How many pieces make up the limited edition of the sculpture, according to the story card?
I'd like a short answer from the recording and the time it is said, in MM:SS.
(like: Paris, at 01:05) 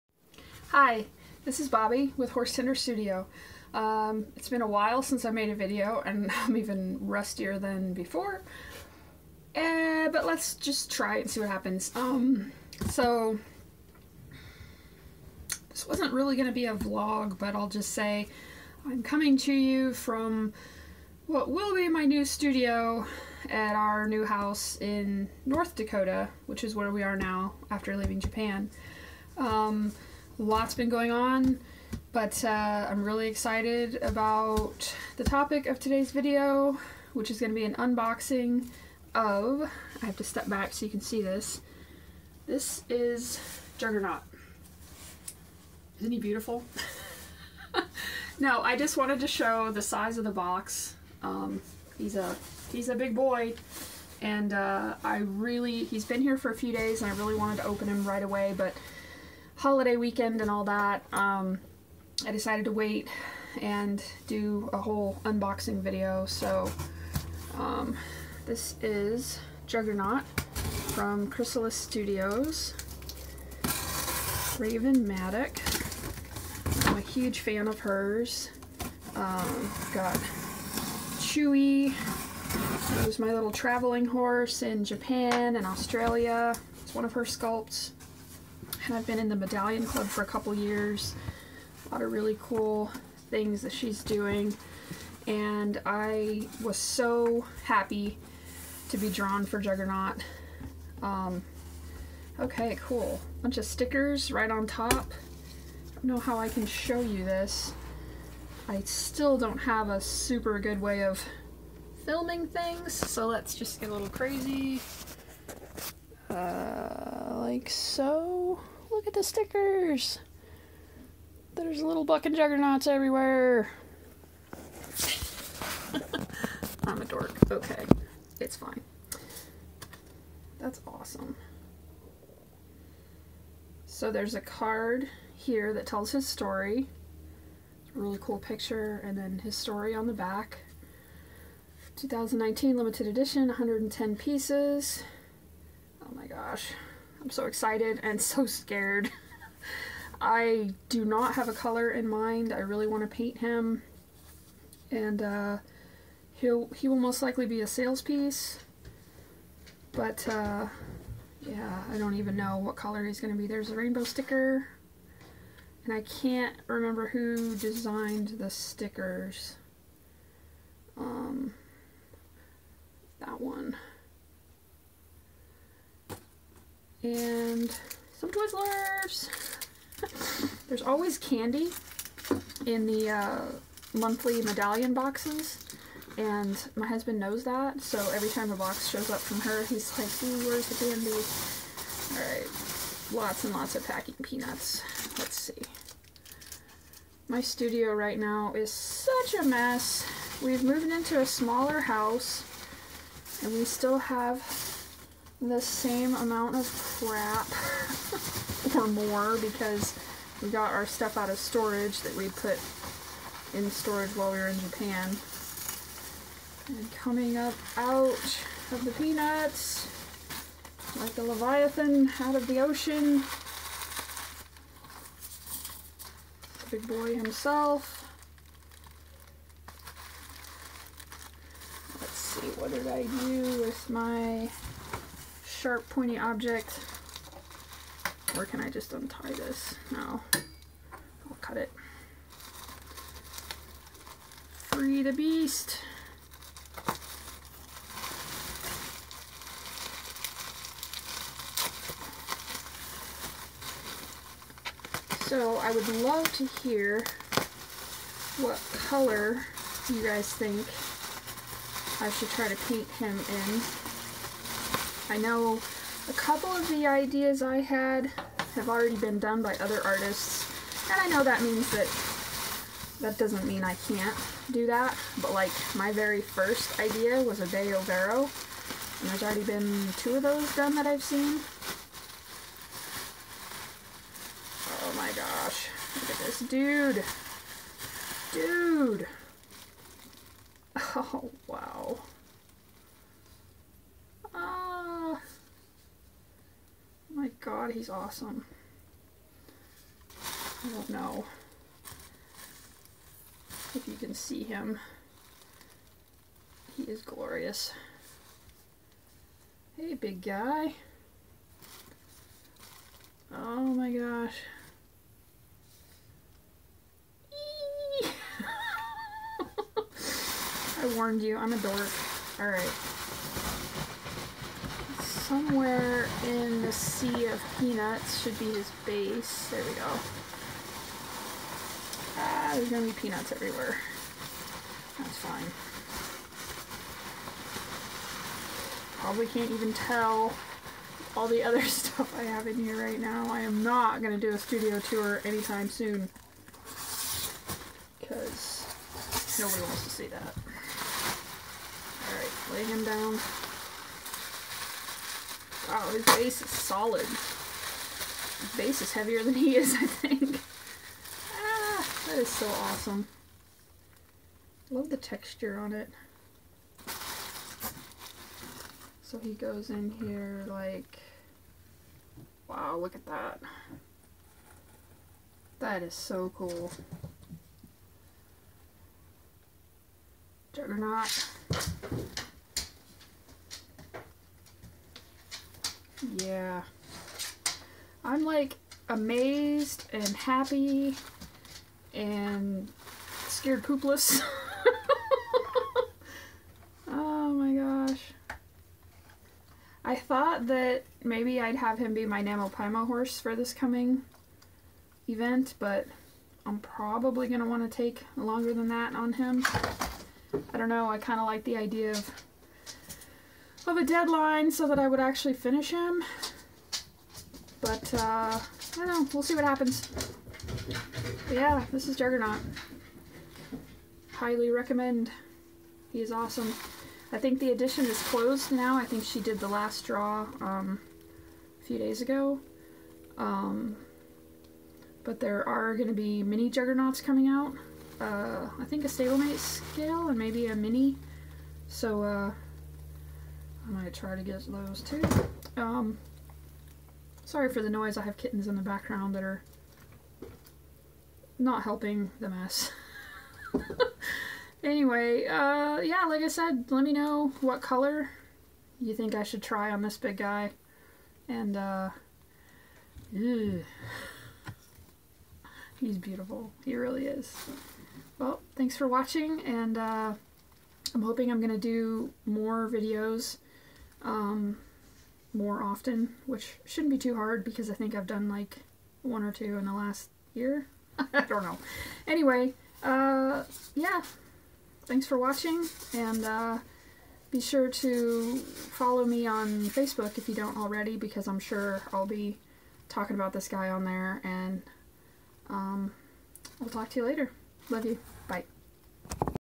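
110, at 02:23.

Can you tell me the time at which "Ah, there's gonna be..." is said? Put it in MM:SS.
05:32.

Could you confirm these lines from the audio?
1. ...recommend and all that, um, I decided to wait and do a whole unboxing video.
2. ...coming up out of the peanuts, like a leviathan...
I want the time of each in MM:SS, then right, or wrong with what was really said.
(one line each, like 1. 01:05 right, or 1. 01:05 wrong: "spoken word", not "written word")
1. 00:59 wrong: "weekend", not "recommend"
2. 03:36 right.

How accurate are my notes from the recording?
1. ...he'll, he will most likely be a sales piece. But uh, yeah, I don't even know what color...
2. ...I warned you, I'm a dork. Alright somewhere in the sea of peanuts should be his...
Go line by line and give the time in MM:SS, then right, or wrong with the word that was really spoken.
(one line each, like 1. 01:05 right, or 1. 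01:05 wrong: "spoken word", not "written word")
1. 02:36 right
2. 05:20 right.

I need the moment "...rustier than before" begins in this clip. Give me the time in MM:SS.
00:07.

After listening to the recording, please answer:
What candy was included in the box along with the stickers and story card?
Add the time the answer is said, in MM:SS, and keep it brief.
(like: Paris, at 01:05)
Twizzlers, at 02:58.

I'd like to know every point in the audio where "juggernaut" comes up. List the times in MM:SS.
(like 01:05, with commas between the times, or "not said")
00:43, 01:09, 01:39, 02:02, 06:20, 07:01, 07:16.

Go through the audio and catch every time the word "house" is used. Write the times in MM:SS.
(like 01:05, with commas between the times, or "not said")
00:24, 03:21.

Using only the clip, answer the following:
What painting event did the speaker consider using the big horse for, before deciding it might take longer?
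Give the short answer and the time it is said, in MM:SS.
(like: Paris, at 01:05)
NaMoPaiMo, at 06:42.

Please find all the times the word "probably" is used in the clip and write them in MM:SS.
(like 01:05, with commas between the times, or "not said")
05:39, 06:46.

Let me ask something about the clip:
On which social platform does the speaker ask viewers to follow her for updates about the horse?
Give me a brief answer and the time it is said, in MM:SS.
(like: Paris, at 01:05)
Facebook, at 08:09.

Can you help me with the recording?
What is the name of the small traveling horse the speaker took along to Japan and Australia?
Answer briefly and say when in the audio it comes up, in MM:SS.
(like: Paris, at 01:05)
Chewy, at 01:21.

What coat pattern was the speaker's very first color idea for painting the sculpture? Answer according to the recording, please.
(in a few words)
De Overo.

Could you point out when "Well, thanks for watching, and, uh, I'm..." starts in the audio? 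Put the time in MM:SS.
07:48.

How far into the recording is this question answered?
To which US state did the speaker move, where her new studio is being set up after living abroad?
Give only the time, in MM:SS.
00:25.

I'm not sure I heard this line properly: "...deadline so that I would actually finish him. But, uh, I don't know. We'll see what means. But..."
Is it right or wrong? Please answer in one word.
wrong.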